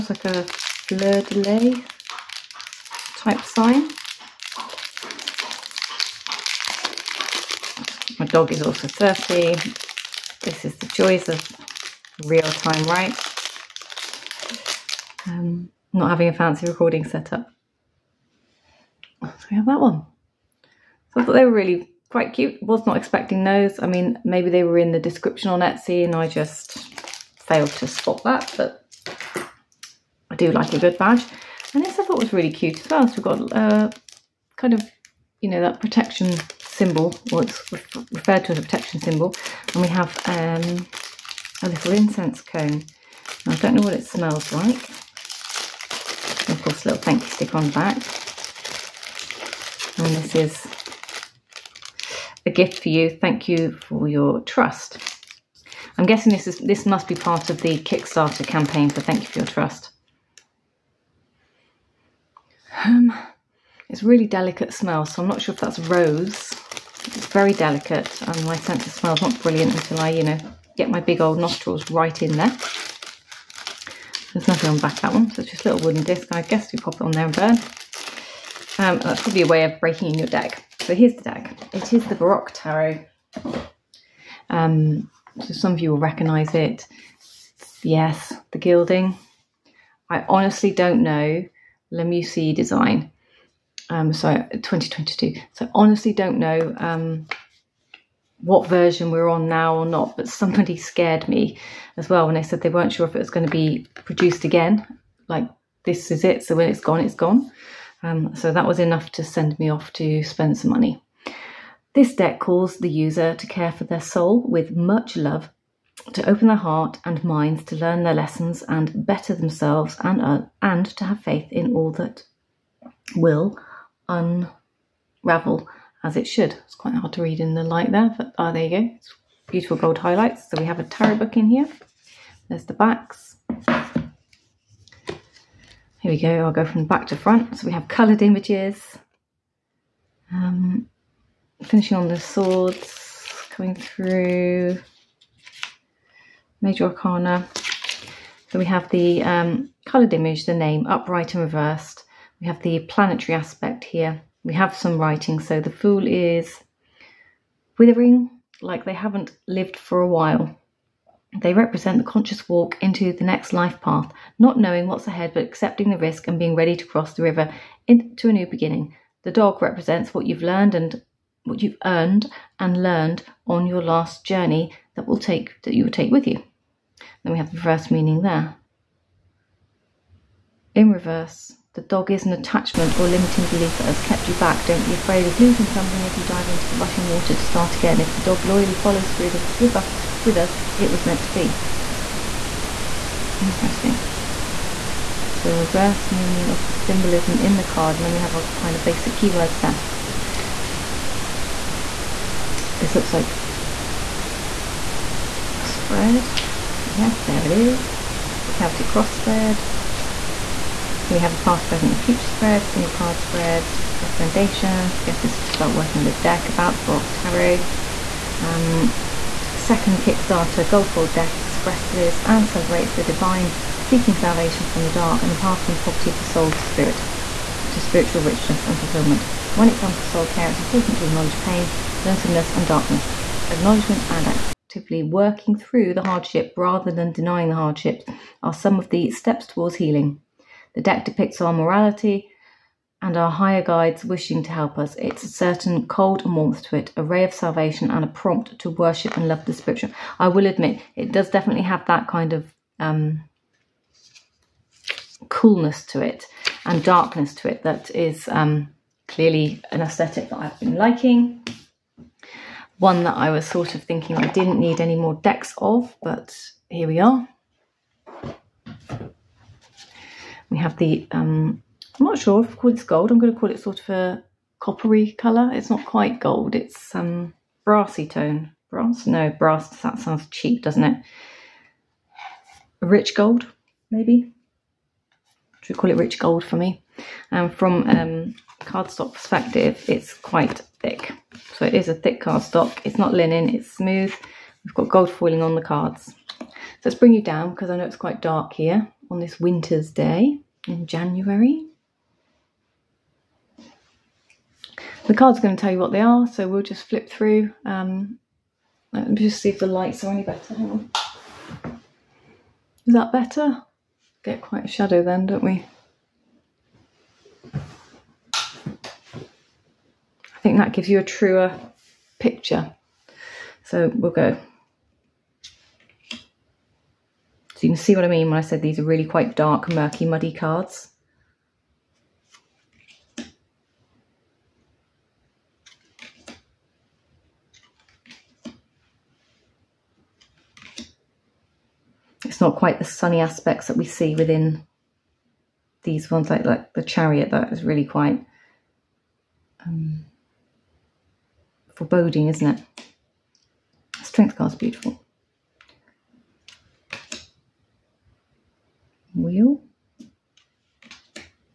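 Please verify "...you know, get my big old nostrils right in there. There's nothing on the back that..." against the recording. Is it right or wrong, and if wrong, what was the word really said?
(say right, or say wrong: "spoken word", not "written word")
right.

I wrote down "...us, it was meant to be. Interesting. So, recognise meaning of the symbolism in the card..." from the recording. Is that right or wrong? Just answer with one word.
wrong.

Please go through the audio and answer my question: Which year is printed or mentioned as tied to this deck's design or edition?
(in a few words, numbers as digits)
2022.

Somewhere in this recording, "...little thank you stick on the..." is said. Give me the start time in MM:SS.
00:46.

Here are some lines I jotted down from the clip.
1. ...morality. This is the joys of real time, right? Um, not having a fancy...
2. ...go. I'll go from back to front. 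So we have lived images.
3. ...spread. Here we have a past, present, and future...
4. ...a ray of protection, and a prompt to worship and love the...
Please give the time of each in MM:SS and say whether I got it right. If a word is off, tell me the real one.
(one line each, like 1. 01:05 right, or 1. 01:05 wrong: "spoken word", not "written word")
1. 00:08 wrong: "thirsty", not "morality"
2. 02:16 wrong: "coloured", not "lived"
3. 03:29 right
4. 04:06 wrong: "salvation", not "protection".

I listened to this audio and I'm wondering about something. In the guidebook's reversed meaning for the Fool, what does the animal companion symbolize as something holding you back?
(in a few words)
limiting belief.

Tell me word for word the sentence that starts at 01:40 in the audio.
But somebody scared me as well when they said they weren't sure if it was going to be produced again.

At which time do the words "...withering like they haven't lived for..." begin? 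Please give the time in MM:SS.
02:37.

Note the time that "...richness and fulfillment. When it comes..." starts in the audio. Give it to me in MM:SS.
03:48.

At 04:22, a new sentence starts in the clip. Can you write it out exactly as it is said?
One that I was sort of thinking I didn't need any more decks of, but here we are.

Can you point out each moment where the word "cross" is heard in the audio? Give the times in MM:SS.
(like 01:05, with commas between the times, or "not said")
02:46, 03:28.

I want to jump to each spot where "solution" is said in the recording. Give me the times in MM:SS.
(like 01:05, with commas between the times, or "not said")
not said.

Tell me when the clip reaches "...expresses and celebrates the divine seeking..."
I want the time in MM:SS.
03:41.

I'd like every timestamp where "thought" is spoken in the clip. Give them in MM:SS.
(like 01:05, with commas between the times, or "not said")
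00:21, 00:32.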